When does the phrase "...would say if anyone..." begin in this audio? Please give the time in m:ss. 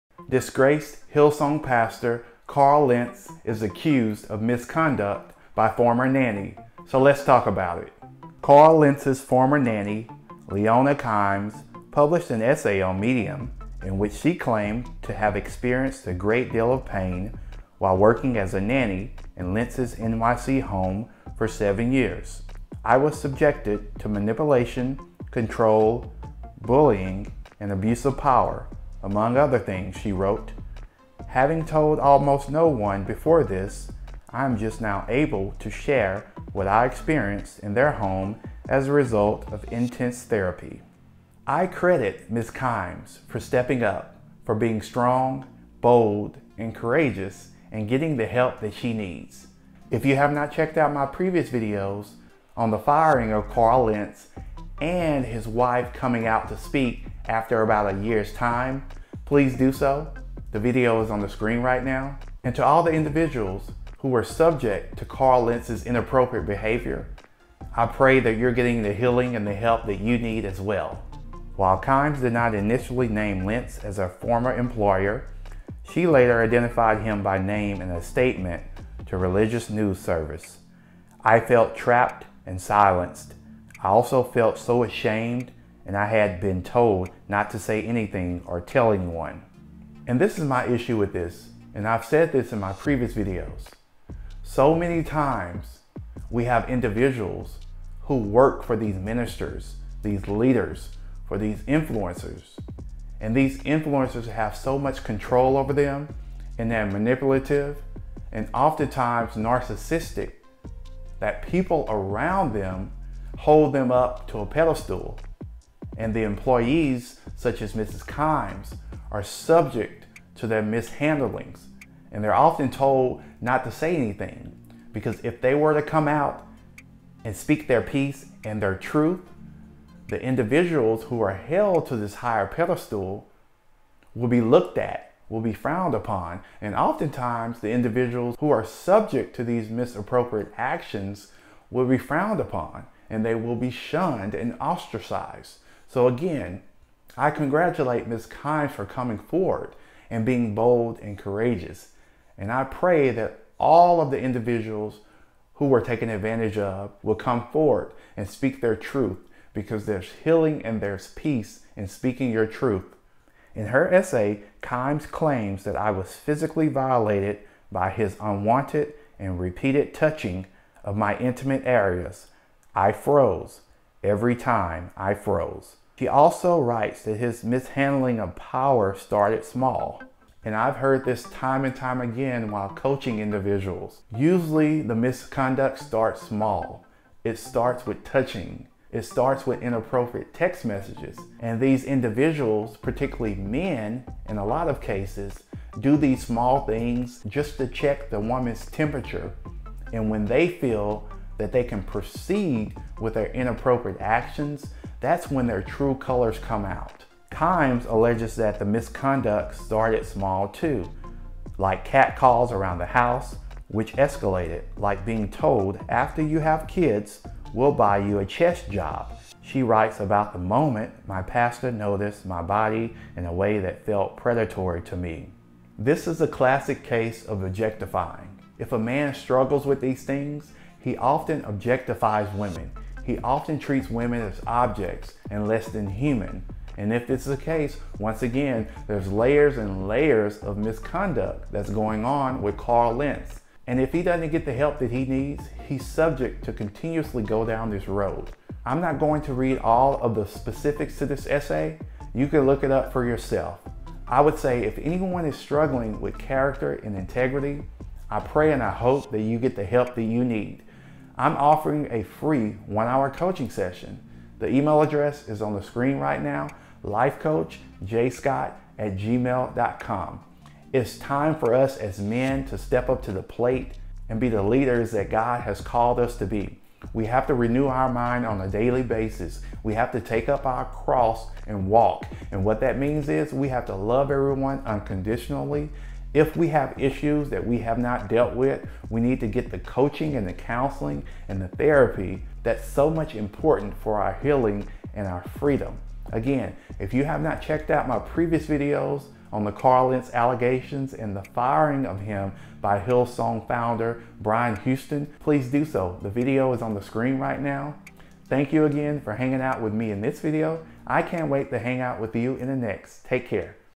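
4:14.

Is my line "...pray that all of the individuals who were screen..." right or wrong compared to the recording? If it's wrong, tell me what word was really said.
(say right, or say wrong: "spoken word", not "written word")
wrong: "taken", not "screen".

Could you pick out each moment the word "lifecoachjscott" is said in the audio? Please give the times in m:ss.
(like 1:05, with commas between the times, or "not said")
4:26.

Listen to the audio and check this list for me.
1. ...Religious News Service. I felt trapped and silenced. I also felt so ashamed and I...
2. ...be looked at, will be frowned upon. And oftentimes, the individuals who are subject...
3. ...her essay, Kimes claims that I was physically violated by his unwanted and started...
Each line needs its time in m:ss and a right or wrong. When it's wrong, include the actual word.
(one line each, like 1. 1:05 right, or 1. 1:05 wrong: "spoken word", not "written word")
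1. 1:19 right
2. 2:14 right
3. 2:43 wrong: "repeated", not "started".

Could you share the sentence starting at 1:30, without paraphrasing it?
And this is my issue with this, and I've said this in my previous videos.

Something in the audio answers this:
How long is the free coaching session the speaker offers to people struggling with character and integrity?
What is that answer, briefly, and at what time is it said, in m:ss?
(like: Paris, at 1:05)
1 hour, at 4:22.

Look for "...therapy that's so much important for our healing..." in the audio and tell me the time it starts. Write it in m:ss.
4:51.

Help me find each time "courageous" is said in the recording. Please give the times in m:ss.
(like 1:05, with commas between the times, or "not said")
0:46, 2:31.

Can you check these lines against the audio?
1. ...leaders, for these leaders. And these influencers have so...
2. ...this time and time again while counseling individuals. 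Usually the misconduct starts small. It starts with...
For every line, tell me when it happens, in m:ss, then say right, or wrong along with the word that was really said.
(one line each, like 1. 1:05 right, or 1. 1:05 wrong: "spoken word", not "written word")
1. 1:40 wrong: "influencers", not "leaders"
2. 3:01 wrong: "coaching", not "counseling".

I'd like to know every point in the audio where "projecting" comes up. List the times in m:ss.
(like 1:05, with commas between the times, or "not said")
not said.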